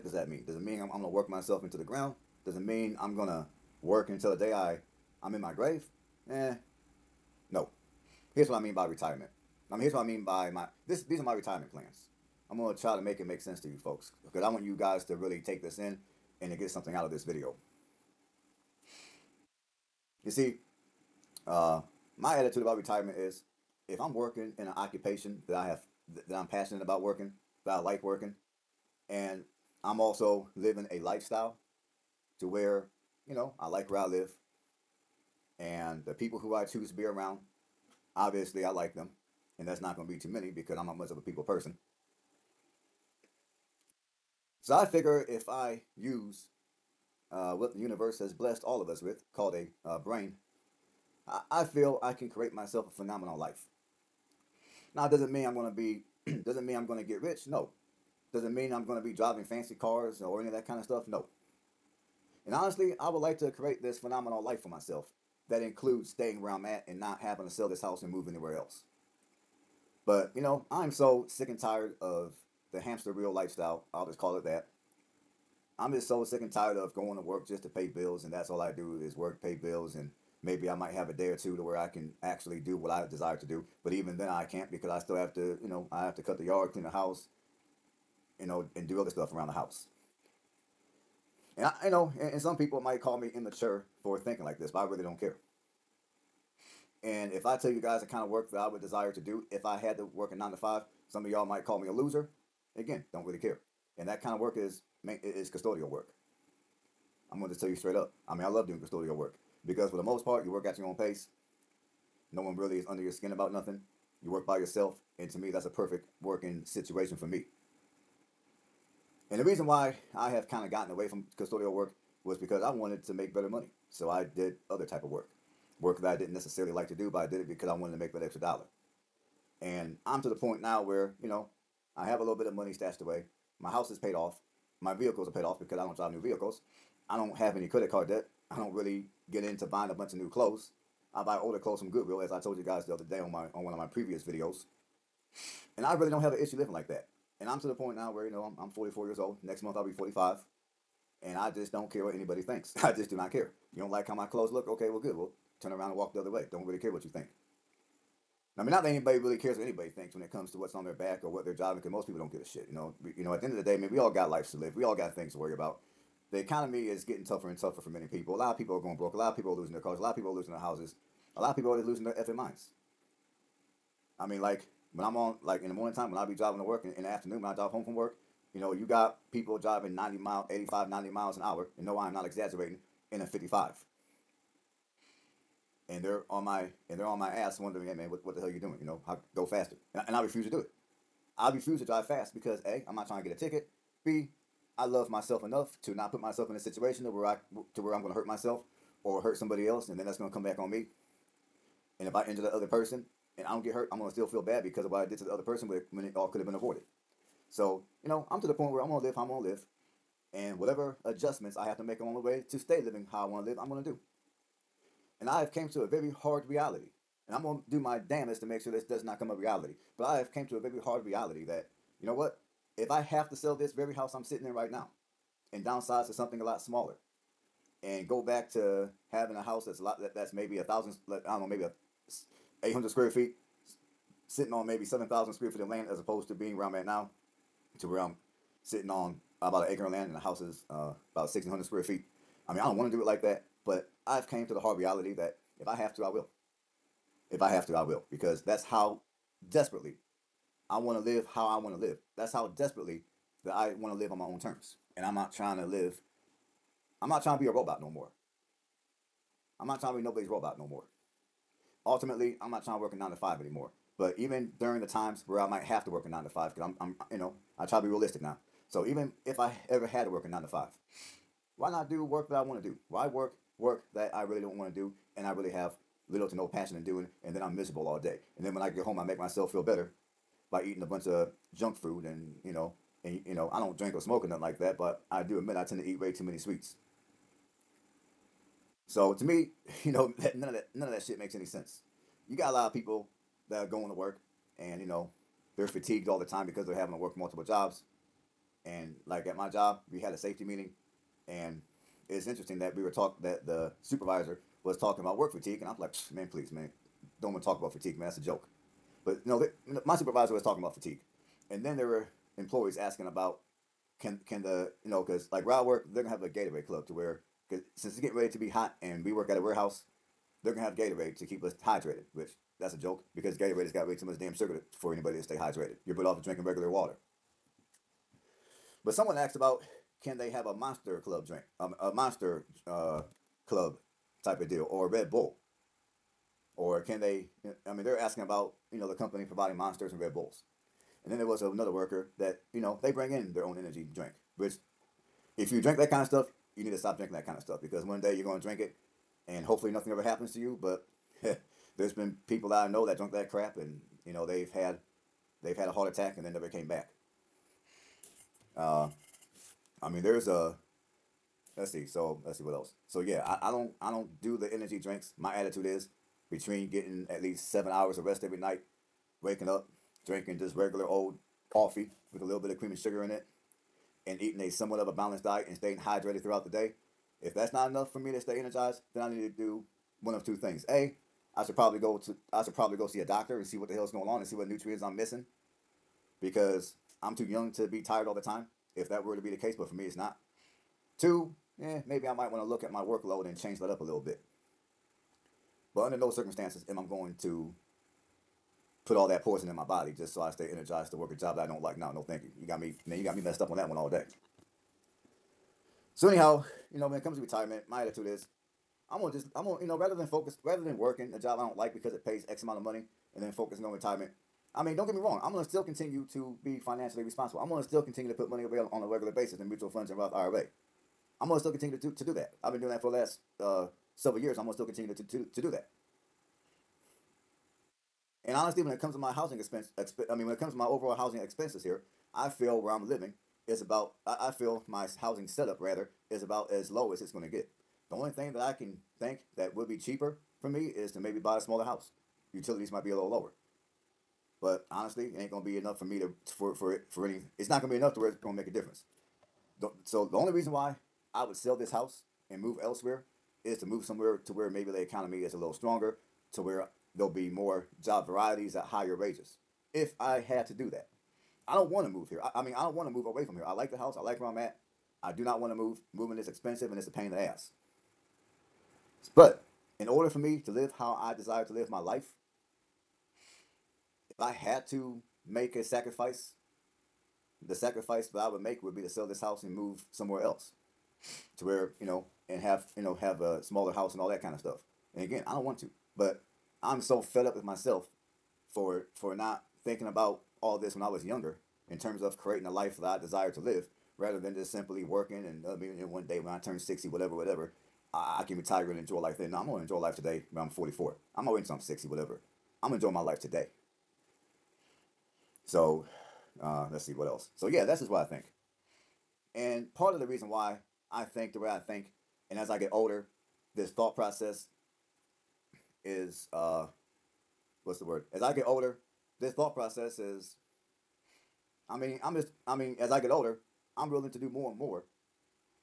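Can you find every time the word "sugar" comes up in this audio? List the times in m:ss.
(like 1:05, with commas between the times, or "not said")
5:24, 6:12.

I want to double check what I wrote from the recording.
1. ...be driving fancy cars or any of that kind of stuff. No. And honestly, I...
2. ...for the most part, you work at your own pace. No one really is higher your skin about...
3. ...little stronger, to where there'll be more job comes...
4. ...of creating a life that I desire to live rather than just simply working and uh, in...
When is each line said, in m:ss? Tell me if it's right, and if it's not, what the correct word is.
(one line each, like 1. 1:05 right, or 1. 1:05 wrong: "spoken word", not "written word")
1. 0:59 right
2. 1:49 wrong: "under", not "higher"
3. 7:35 wrong: "varieties", not "comes"
4. 8:12 right.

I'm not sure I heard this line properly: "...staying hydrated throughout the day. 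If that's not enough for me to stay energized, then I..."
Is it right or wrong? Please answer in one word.
right.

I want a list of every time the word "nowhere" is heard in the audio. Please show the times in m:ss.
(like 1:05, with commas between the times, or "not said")
not said.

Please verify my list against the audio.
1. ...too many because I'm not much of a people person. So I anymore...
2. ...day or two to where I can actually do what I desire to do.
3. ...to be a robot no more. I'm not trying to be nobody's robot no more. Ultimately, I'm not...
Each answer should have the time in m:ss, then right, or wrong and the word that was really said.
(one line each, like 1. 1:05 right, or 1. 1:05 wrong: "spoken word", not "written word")
1. 0:40 wrong: "figure", not "anymore"
2. 1:21 right
3. 4:17 right.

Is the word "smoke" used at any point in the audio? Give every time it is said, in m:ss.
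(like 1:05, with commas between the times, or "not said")
4:43.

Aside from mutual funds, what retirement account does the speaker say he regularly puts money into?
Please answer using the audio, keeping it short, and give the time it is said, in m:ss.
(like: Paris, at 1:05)
Roth IRA, at 6:59.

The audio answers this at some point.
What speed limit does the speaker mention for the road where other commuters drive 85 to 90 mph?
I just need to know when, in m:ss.
3:03.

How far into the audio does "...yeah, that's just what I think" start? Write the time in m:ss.
8:27.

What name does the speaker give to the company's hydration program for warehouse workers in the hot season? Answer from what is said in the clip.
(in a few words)
Gatorade club.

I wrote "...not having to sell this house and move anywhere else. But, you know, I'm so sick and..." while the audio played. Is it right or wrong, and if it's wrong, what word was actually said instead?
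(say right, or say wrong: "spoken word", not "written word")
right.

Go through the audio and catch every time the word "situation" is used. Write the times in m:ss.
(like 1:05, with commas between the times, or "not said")
1:56, 3:16.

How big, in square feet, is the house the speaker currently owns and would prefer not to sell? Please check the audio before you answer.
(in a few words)
1,600.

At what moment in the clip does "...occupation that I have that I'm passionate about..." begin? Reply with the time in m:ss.
0:24.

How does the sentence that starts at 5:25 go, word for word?
You're better off drinking regular water.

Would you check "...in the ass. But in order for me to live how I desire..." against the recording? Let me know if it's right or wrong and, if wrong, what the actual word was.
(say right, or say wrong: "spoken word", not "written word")
right.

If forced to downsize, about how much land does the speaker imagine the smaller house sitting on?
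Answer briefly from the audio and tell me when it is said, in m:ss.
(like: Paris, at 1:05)
7,000 square feet, at 3:54.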